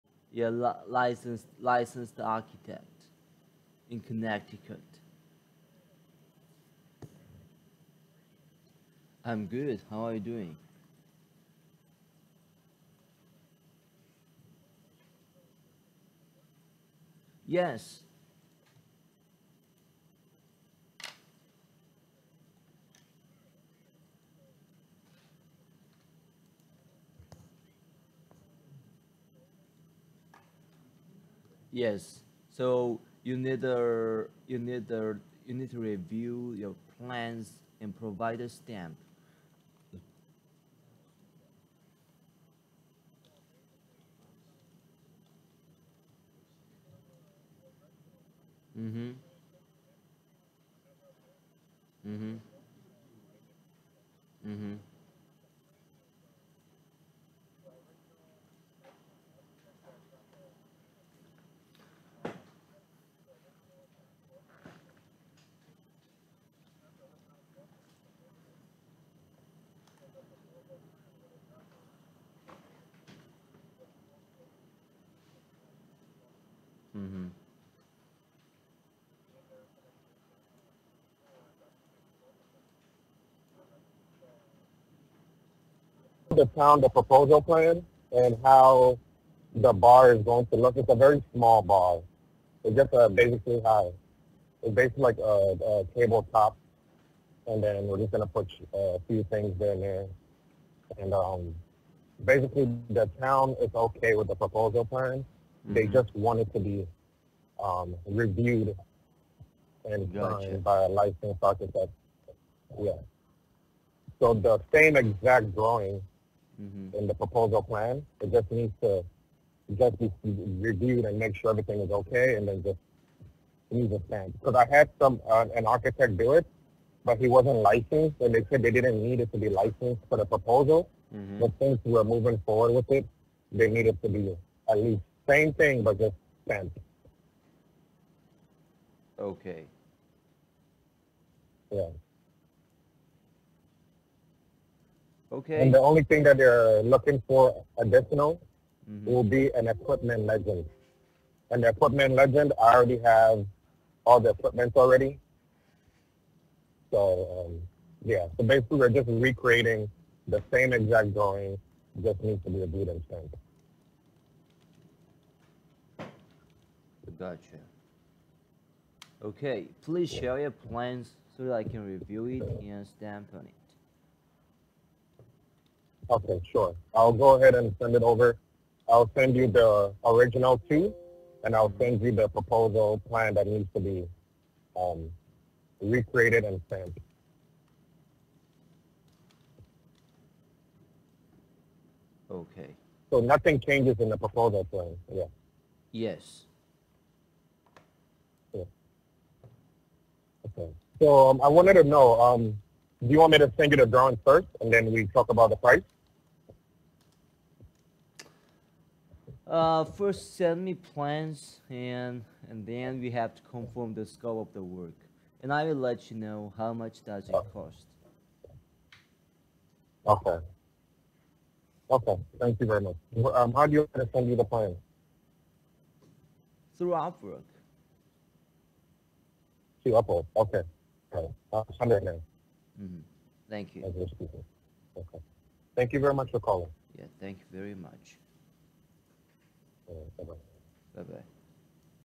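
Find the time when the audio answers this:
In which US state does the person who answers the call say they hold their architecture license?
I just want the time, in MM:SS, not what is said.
00:03.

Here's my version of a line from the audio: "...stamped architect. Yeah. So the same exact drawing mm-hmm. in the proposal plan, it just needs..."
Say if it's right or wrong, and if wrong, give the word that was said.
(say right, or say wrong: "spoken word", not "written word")
wrong: "licensed", not "stamped".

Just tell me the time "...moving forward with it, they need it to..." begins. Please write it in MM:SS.
02:12.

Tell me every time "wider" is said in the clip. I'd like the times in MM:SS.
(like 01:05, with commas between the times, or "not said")
not said.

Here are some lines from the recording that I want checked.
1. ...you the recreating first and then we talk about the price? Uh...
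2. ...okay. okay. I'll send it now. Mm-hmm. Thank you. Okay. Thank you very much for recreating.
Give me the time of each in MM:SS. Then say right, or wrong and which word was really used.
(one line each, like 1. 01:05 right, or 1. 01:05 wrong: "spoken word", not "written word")
1. 03:23 wrong: "drawing", not "recreating"
2. 03:50 wrong: "calling", not "recreating".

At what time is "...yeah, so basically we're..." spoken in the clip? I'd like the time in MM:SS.
02:38.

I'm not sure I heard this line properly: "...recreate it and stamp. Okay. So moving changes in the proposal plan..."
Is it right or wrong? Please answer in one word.
wrong.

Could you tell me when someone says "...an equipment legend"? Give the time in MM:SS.
02:29.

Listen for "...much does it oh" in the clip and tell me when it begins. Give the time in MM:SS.
03:36.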